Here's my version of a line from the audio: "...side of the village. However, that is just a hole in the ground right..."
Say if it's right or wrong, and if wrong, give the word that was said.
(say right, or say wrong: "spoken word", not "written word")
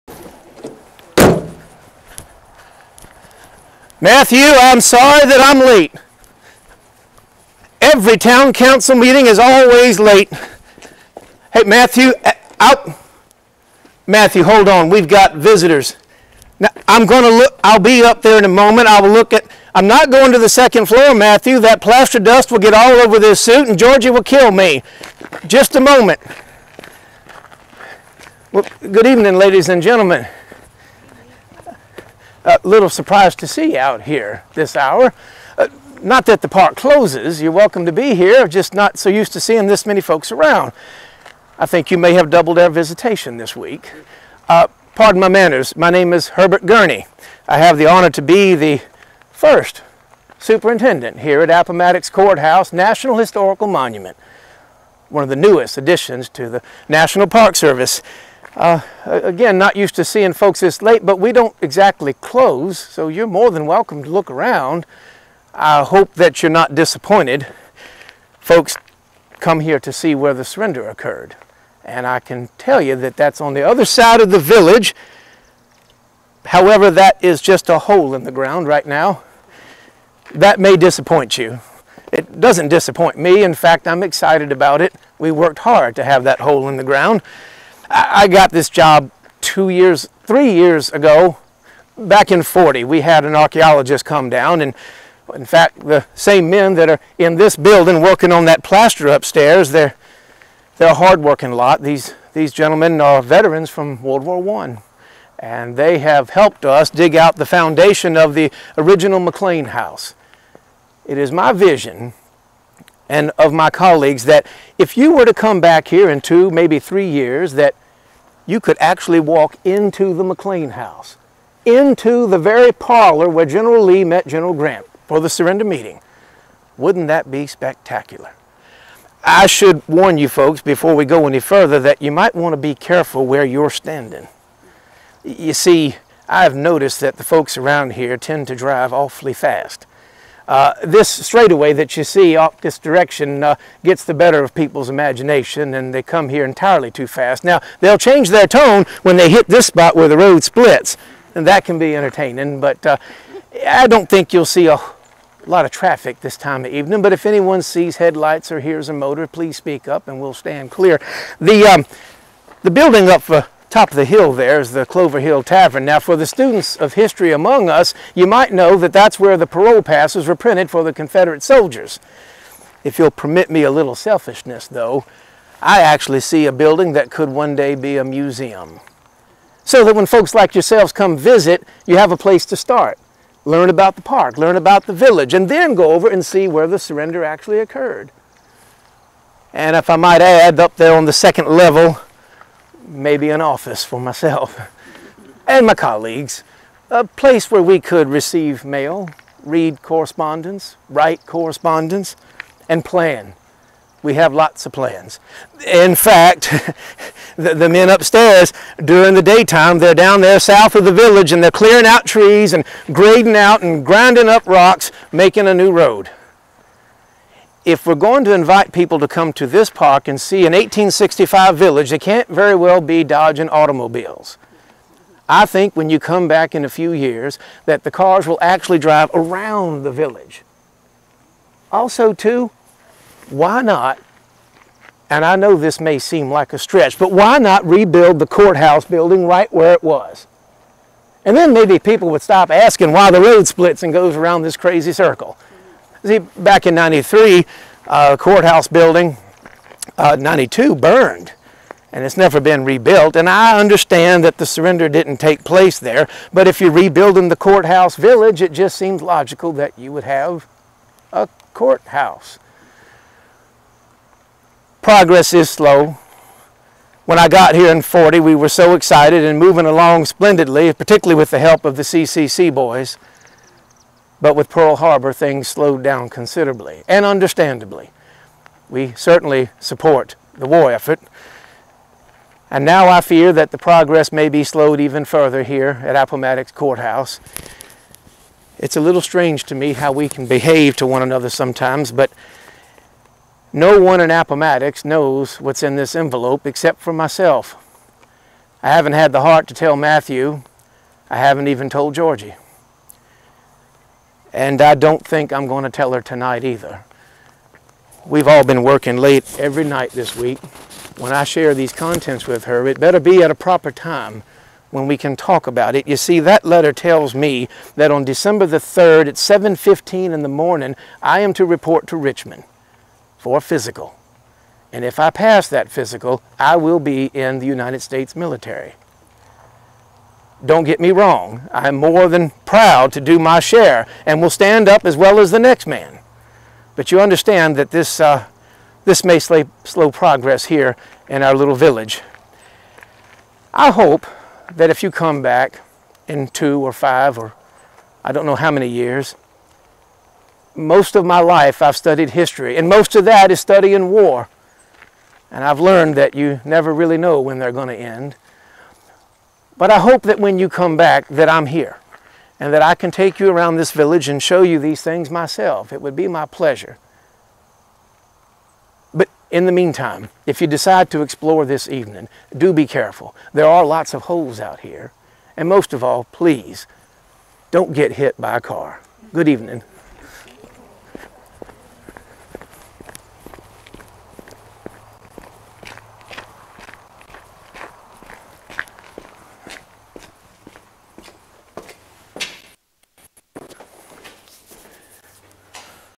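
right.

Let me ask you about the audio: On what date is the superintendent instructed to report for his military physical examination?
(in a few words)
December 3.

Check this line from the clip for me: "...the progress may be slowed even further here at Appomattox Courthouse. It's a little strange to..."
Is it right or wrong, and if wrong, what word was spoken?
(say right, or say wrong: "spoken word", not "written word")
right.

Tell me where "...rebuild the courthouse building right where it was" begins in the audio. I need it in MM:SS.
03:57.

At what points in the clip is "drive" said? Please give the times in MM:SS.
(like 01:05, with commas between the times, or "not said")
02:18, 03:48.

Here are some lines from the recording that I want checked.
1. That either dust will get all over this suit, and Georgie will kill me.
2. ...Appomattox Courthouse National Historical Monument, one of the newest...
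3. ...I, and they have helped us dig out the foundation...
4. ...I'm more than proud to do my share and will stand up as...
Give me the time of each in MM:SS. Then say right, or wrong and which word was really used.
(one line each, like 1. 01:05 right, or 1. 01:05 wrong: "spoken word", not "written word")
1. 00:21 wrong: "plaster", not "either"
2. 00:51 right
3. 01:44 right
4. 05:31 right.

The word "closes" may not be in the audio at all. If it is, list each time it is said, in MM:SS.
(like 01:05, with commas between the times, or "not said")
00:36, 01:02.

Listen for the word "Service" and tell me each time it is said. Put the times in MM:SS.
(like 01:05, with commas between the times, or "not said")
00:57.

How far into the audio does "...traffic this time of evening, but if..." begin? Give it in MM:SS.
02:35.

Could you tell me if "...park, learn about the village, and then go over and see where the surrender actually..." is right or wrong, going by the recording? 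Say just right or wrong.
right.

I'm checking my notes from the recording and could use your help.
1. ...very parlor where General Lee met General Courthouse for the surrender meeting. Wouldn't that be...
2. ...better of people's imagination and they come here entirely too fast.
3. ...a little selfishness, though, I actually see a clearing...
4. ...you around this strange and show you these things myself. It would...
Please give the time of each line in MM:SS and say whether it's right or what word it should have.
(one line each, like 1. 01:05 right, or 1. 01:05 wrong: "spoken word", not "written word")
1. 02:02 wrong: "Grant", not "Courthouse"
2. 02:24 right
3. 02:53 wrong: "building", not "clearing"
4. 06:03 wrong: "village", not "strange".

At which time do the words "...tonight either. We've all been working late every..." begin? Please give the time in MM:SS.
05:06.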